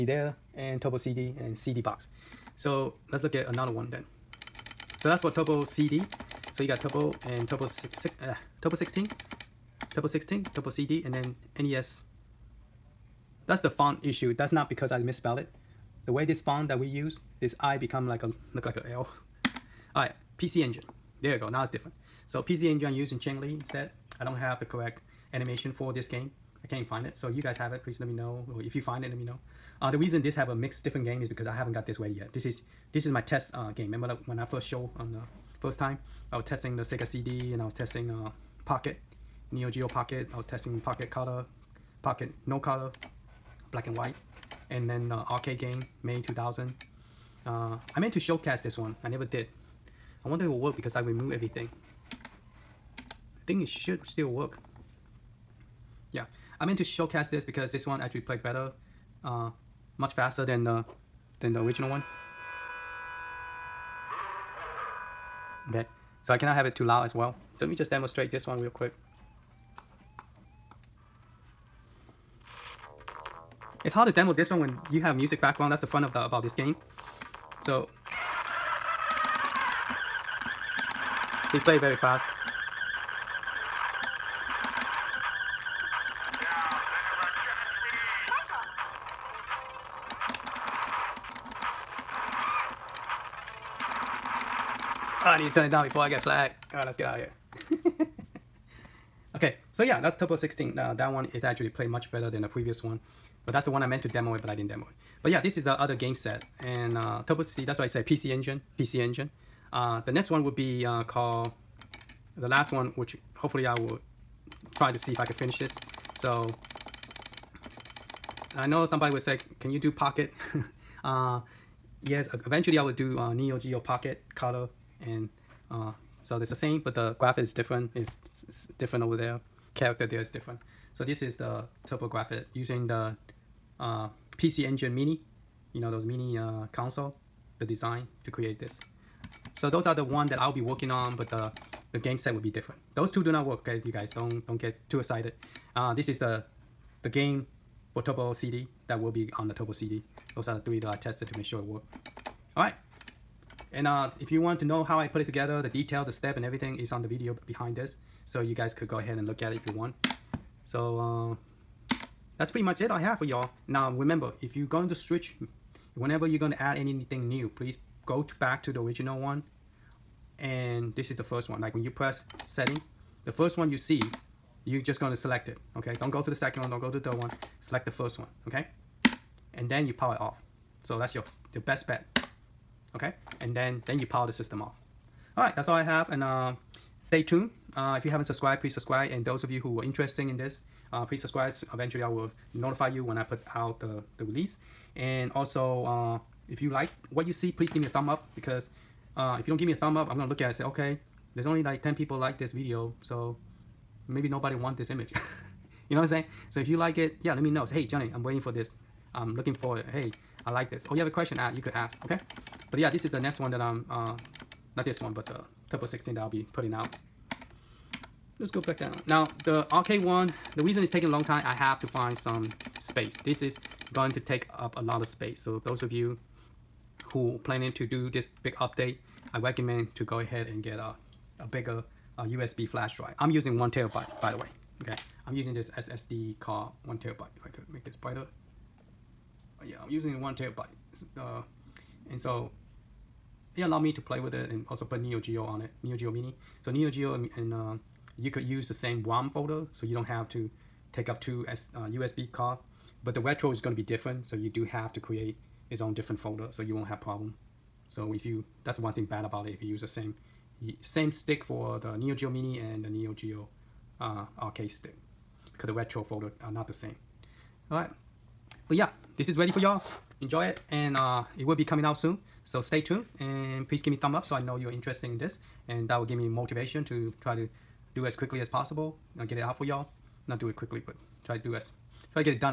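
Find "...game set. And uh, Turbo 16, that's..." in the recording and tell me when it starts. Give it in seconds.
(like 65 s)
105 s.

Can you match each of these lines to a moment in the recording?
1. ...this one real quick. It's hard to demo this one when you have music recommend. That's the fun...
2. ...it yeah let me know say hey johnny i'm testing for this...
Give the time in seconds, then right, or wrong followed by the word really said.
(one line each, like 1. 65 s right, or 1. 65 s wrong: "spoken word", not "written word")
1. 68 s wrong: "background", not "recommend"
2. 206 s wrong: "waiting", not "testing".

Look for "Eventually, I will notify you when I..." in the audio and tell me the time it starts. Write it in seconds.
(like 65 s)
191 s.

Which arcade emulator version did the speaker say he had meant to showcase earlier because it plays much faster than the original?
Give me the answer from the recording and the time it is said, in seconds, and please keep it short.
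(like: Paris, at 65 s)
MAME 2000, at 46 s.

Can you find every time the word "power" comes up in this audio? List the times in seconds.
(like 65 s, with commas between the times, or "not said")
179 s, 184 s.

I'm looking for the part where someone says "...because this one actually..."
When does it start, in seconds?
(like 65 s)
57 s.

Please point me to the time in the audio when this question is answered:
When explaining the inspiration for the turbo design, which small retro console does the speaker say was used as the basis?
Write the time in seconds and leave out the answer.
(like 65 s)
134 s.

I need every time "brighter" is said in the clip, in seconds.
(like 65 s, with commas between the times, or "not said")
237 s.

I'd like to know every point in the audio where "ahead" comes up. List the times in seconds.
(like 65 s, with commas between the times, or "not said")
158 s, 230 s.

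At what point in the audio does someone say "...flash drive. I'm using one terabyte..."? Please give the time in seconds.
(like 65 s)
232 s.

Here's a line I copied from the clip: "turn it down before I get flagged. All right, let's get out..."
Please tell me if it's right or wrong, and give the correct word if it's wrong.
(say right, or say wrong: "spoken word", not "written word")
right.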